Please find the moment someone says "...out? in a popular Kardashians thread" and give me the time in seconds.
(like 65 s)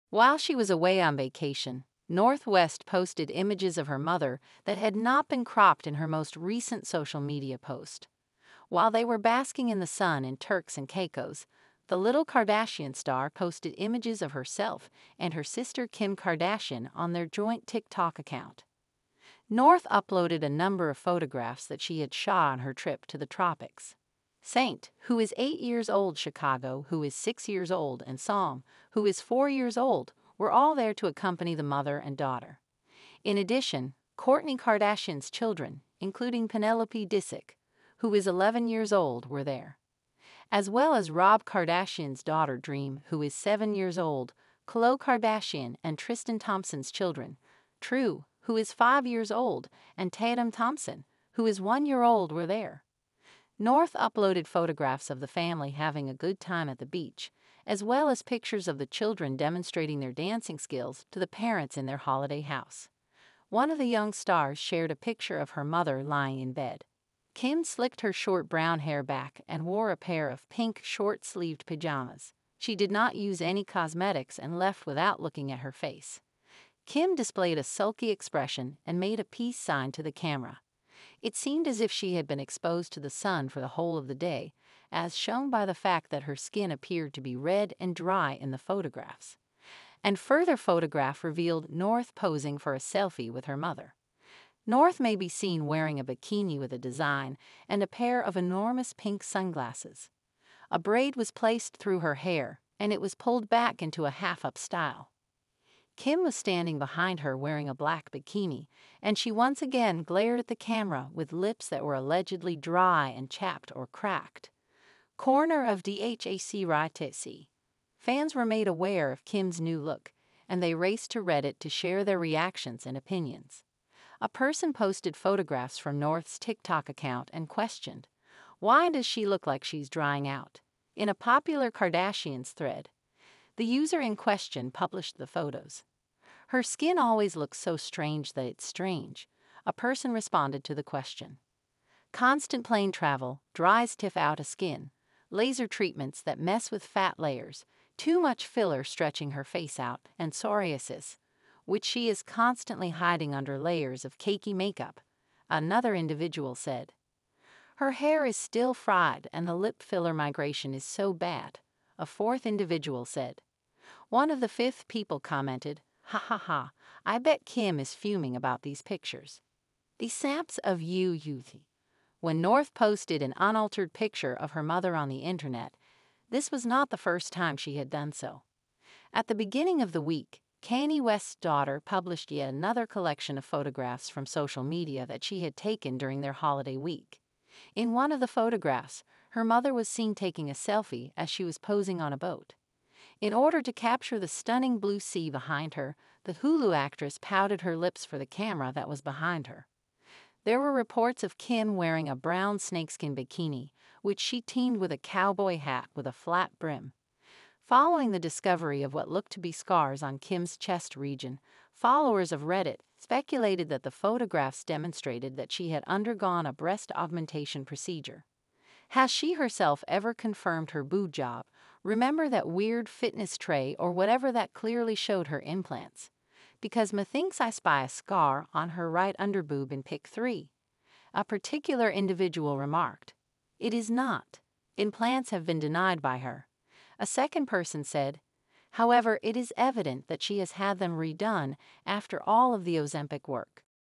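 130 s.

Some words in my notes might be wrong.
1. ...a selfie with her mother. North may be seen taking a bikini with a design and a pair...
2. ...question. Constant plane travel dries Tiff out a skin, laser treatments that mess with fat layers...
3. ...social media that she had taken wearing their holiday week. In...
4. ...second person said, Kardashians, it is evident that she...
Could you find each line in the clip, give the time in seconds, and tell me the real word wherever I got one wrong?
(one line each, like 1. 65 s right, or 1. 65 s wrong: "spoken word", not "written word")
1. 92 s wrong: "wearing", not "taking"
2. 140 s right
3. 184 s wrong: "during", not "wearing"
4. 237 s wrong: "However", not "Kardashians".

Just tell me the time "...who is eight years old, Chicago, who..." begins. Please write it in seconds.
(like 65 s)
25 s.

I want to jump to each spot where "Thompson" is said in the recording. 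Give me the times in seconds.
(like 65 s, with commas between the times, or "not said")
46 s, 50 s.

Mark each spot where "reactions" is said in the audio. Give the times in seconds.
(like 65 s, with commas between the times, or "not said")
122 s.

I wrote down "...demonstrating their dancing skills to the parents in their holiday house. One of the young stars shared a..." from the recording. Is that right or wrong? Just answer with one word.
right.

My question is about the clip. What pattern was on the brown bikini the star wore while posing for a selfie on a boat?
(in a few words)
Snakeskin.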